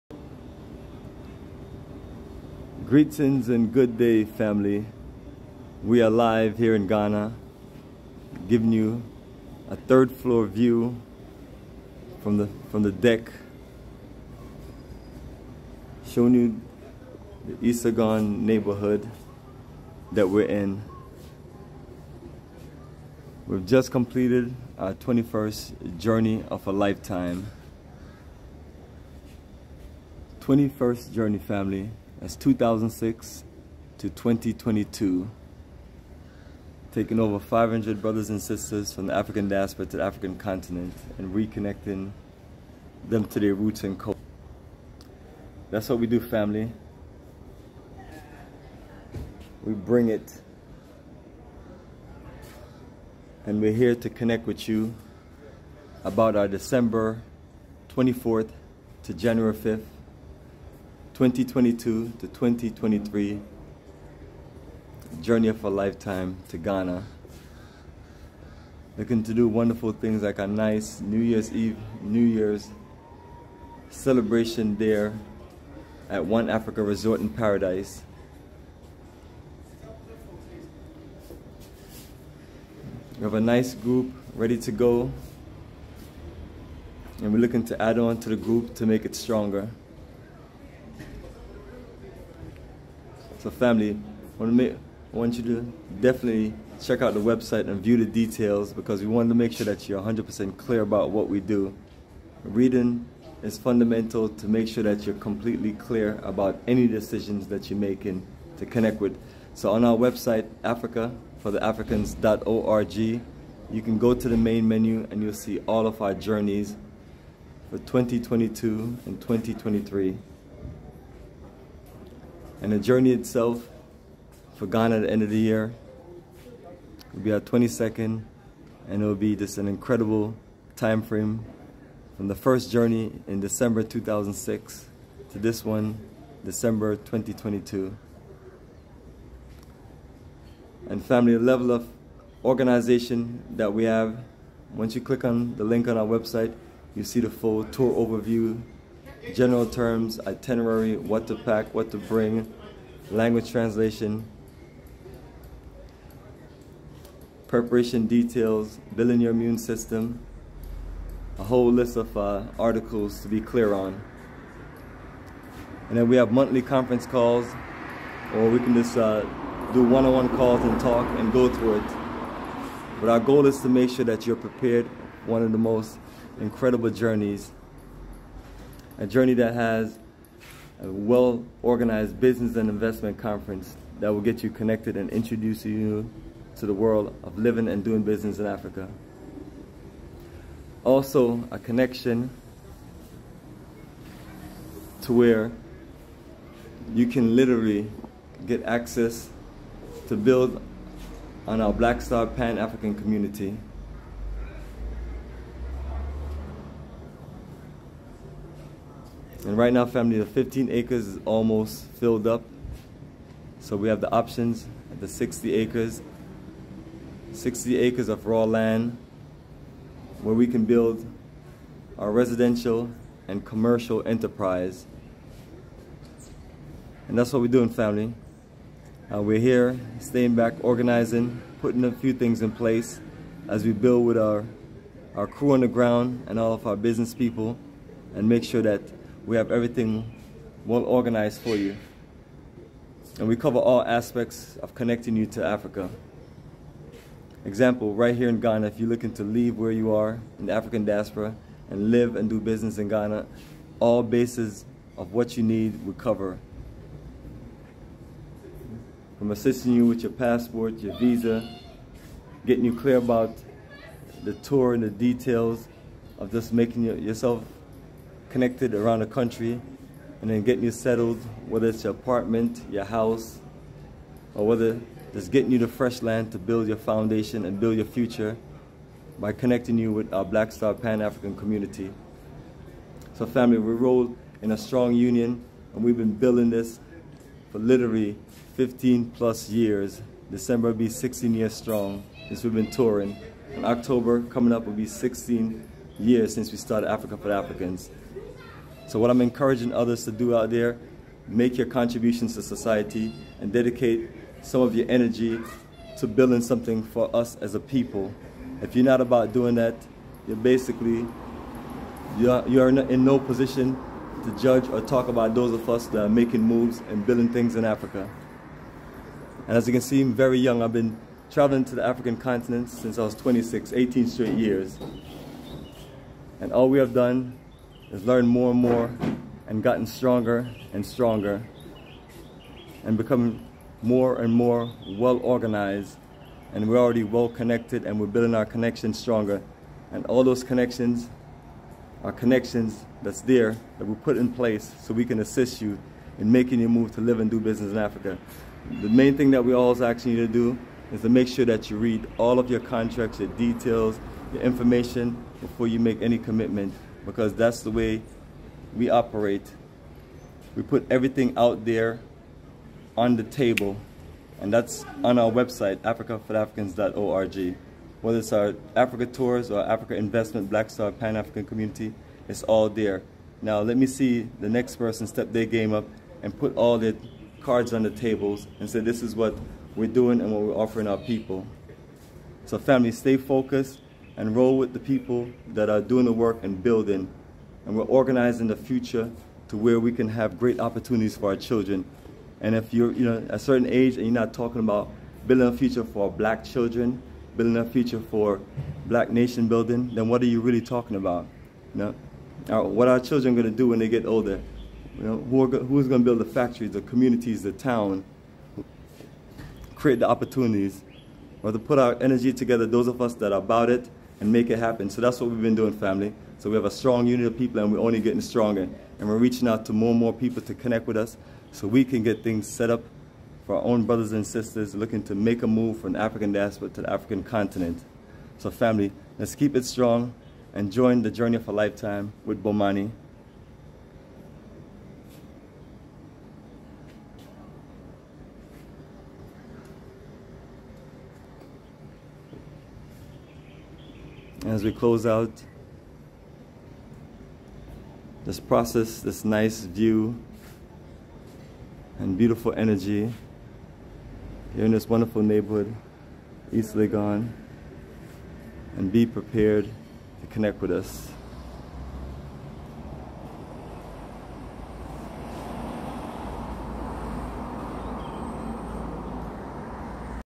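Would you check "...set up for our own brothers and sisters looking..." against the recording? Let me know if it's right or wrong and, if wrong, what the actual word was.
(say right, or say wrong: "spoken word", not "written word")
right.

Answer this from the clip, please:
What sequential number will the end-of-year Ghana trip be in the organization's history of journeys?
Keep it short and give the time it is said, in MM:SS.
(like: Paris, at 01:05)
22nd, at 02:07.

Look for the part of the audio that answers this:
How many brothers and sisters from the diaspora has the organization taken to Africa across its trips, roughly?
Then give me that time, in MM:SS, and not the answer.
00:37.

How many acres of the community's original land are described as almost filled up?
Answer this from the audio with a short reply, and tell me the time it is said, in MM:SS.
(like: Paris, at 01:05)
15 acres, at 03:30.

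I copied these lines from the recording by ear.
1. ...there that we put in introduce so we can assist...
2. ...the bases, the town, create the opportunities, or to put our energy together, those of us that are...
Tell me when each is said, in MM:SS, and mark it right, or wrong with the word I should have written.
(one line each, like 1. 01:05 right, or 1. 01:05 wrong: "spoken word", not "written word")
1. 05:43 wrong: "place", not "introduce"
2. 06:46 wrong: "communities", not "bases".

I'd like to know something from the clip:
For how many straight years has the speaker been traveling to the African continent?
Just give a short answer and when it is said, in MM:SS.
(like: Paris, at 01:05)
18, at 05:23.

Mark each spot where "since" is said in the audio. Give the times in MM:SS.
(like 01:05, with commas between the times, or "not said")
04:52, 04:56, 05:22.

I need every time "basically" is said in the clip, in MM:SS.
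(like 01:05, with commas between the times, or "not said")
05:10.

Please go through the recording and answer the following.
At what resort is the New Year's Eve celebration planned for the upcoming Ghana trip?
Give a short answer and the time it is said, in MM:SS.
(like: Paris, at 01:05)
One Africa Resort, at 01:16.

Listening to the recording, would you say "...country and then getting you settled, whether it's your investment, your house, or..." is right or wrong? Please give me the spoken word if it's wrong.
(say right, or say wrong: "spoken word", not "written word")
wrong: "apartment", not "investment".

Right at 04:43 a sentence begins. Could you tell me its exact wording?
So family, we roll in a strong union and we've been building this for literally 15 plus years.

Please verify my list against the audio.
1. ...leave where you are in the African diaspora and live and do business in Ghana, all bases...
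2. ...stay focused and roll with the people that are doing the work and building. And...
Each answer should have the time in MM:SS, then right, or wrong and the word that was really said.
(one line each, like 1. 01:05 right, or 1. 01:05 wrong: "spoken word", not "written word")
1. 04:09 right
2. 06:22 right.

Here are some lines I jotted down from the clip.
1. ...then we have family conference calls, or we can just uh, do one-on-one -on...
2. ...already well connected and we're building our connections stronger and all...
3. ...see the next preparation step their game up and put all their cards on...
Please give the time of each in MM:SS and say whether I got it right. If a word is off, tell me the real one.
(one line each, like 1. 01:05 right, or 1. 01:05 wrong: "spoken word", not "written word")
1. 02:45 wrong: "monthly", not "family"
2. 05:36 right
3. 06:13 wrong: "person", not "preparation".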